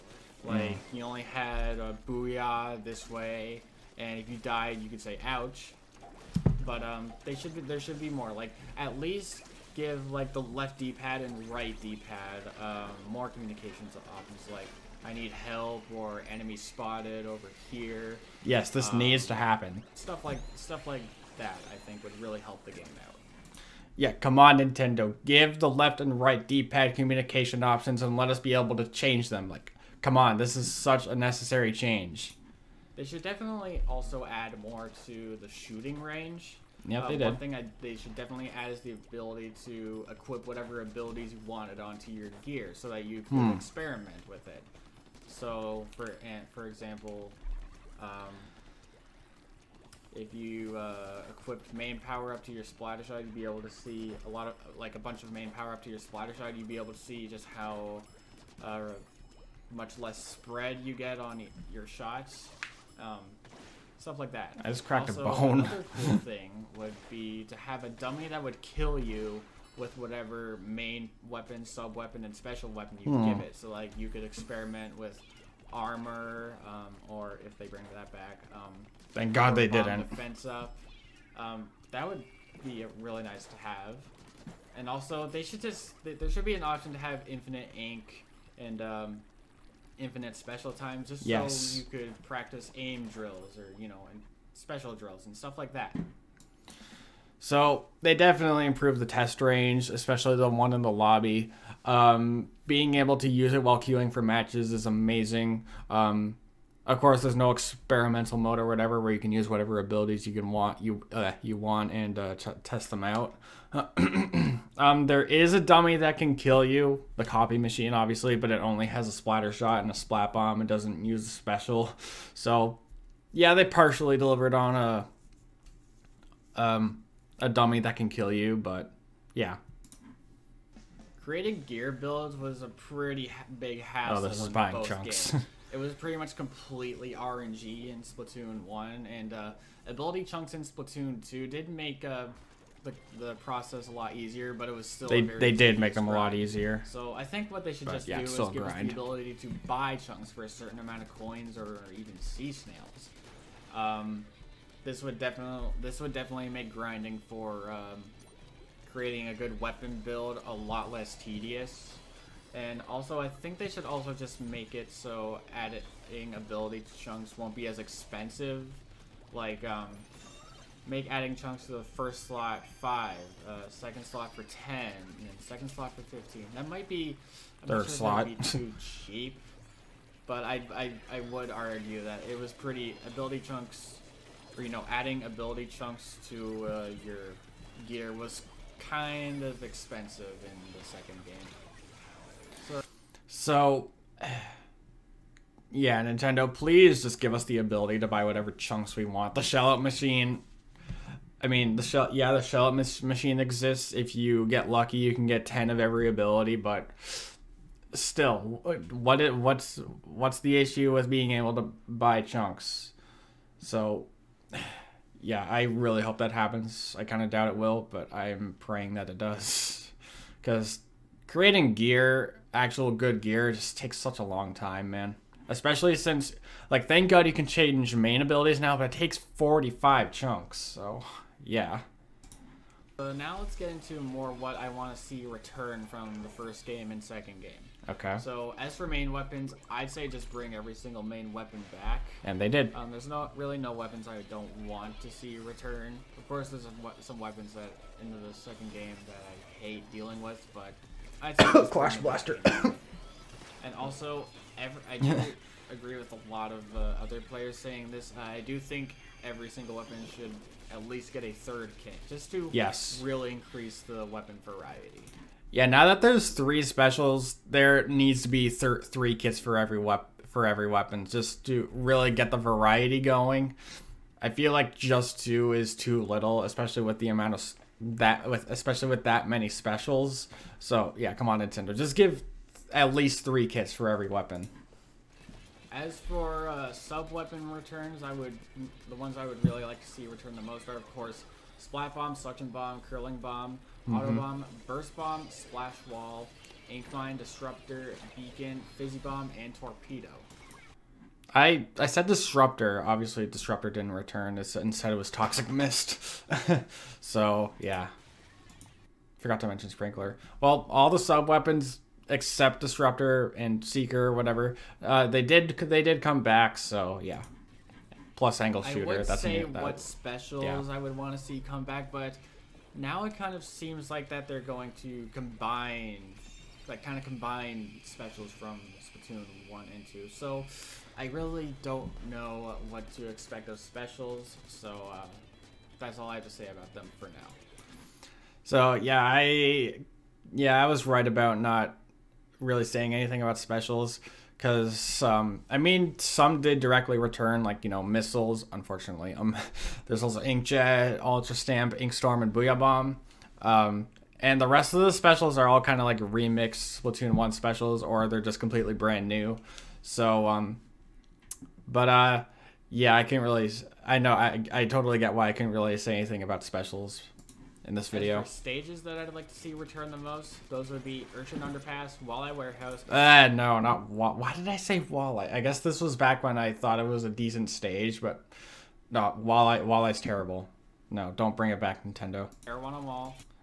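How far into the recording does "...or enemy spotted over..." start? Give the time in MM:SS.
00:15.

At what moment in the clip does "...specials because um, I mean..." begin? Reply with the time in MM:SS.
05:43.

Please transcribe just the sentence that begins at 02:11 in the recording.
Creating gear builds was a pretty big oh, hassle.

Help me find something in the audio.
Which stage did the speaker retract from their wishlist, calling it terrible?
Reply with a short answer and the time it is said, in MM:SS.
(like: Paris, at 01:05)
Walleye Warehouse, at 06:12.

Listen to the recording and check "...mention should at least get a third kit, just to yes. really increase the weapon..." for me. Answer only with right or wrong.
wrong.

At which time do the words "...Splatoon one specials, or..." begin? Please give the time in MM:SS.
05:56.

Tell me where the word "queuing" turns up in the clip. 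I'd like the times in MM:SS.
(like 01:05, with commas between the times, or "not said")
01:43.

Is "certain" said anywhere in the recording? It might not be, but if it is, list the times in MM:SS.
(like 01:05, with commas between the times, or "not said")
02:30.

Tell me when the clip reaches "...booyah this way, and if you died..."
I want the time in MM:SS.
00:02.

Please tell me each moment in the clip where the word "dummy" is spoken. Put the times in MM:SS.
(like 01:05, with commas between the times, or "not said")
01:07, 01:55, 02:07.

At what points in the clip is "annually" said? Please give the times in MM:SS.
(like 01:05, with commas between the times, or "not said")
not said.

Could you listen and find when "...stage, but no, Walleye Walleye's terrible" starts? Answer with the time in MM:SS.
06:17.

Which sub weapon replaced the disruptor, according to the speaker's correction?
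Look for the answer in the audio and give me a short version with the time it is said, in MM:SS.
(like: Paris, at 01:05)
Toxic Mist, at 05:05.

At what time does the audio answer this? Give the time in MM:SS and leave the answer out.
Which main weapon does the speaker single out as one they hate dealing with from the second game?
04:11.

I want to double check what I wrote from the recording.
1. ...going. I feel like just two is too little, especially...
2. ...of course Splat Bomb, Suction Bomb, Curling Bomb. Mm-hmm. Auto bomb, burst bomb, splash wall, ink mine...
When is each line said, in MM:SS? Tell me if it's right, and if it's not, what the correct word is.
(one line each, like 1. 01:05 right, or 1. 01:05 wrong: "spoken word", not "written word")
1. 04:32 right
2. 04:50 right.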